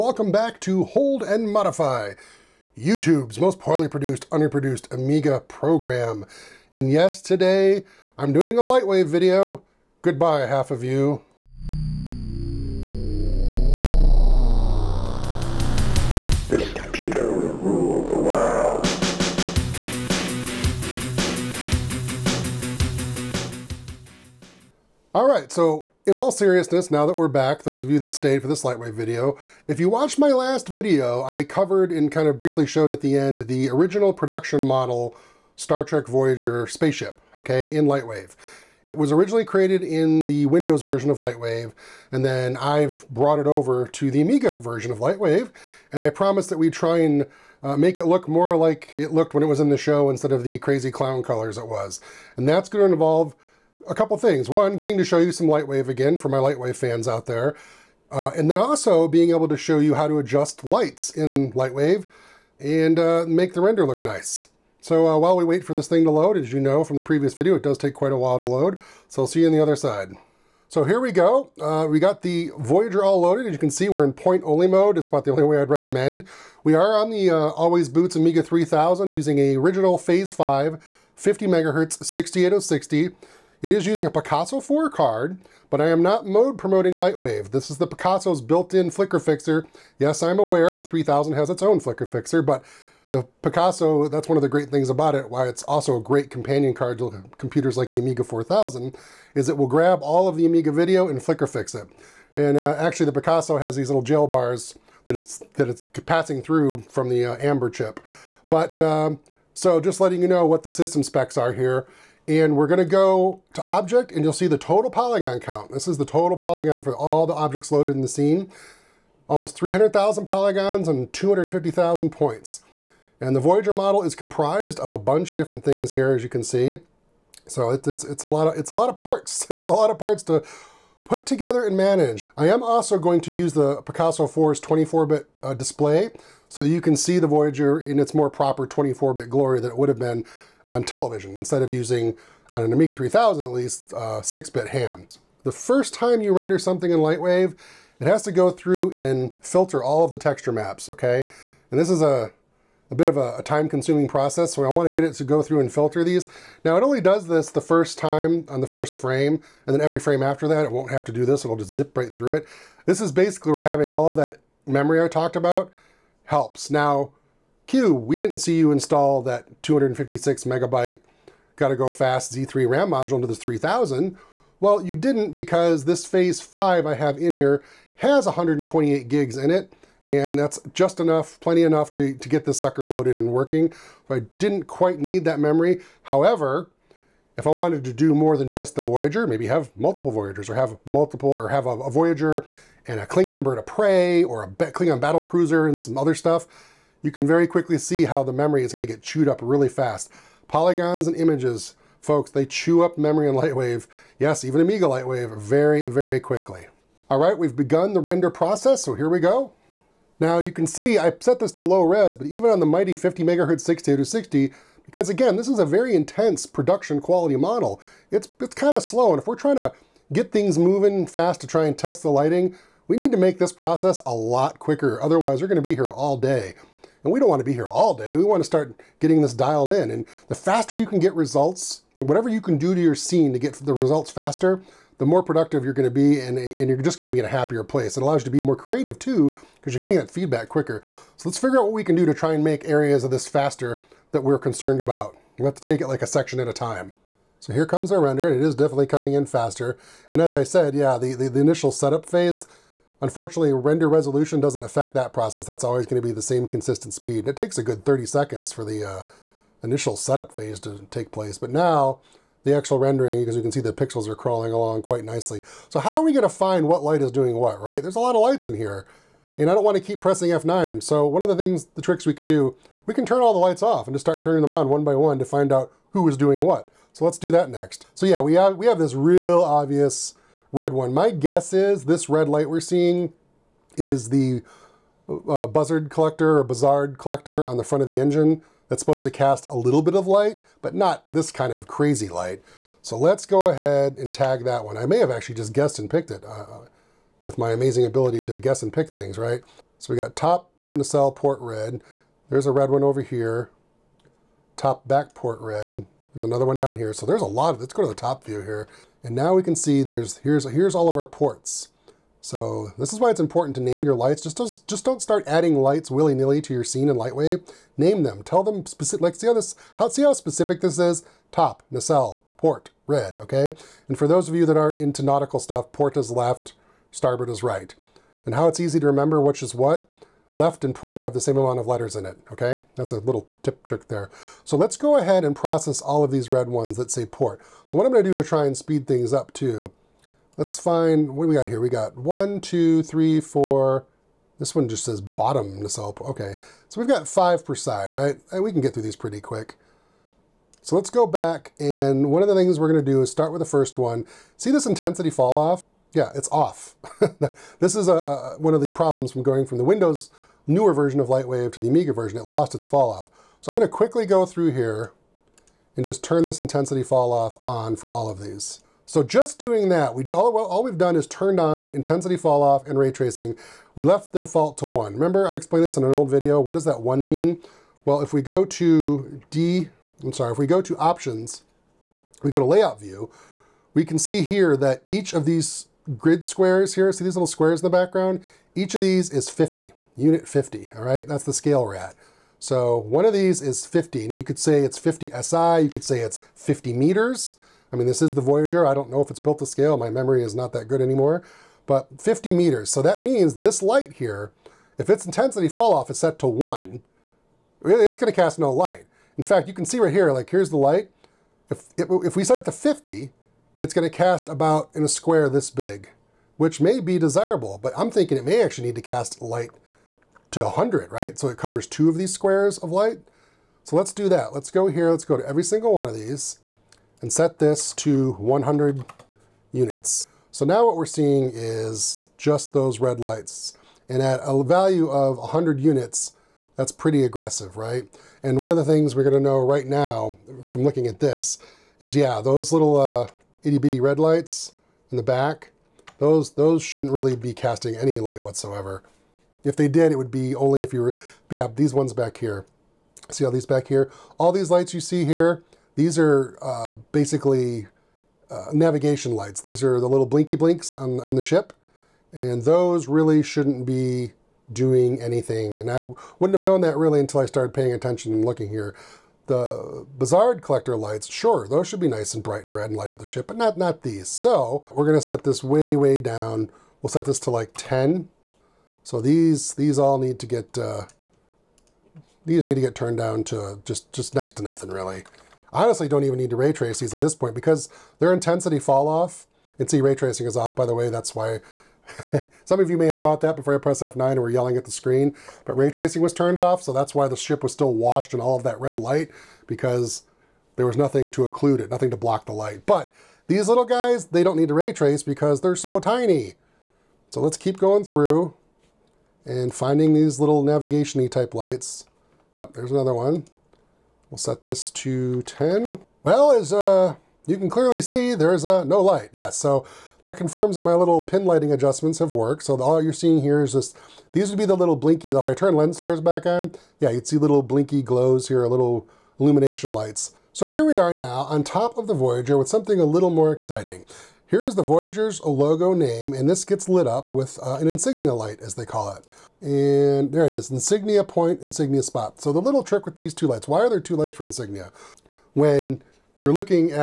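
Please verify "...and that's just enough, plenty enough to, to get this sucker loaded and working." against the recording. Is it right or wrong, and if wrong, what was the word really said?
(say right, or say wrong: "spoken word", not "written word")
right.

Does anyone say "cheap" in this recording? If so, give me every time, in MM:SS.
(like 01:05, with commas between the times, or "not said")
not said.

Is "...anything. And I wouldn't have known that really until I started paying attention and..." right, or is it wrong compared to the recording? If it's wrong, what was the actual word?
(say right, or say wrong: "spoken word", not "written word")
right.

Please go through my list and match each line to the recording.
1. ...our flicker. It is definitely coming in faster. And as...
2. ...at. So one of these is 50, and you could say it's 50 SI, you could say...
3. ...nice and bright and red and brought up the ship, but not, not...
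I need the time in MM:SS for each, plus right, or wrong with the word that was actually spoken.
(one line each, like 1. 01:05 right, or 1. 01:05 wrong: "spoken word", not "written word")
1. 04:07 wrong: "render", not "flicker"
2. 06:31 right
3. 07:51 wrong: "light", not "brought".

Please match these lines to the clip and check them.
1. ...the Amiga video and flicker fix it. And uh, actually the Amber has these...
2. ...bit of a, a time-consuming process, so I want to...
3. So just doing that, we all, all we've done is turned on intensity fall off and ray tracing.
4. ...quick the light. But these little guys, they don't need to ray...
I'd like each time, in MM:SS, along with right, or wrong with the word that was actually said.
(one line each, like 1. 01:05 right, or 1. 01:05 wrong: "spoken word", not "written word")
1. 01:40 wrong: "Picasso", not "Amber"
2. 02:32 right
3. 06:08 right
4. 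08:21 wrong: "block", not "quick".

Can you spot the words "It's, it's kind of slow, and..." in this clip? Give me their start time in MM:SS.
03:38.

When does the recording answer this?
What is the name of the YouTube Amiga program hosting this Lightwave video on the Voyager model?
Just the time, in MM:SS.
00:00.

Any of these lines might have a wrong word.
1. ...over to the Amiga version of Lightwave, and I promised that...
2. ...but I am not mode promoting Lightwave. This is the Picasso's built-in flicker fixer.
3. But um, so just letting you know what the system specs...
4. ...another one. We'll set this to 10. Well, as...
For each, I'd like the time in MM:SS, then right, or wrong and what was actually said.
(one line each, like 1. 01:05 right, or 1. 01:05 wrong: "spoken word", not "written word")
1. 00:43 right
2. 01:25 right
3. 01:48 right
4. 08:32 right.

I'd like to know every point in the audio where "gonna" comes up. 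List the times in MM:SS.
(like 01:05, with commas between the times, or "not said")
01:52, 03:45, 05:37, 05:52, 06:47, 07:54.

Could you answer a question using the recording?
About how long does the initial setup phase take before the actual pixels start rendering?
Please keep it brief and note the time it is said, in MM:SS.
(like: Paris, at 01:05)
30 seconds, at 04:17.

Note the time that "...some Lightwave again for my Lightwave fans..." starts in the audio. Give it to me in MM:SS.
00:55.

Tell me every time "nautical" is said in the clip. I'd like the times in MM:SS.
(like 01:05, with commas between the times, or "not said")
05:25.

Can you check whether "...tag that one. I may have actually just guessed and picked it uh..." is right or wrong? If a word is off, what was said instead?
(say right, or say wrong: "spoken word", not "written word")
right.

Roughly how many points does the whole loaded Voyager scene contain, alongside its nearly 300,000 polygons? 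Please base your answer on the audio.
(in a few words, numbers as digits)
250,000.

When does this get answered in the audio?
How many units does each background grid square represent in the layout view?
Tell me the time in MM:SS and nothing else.
06:28.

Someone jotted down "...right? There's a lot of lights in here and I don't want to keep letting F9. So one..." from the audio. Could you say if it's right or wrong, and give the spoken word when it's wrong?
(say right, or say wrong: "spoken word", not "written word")
wrong: "pressing", not "letting".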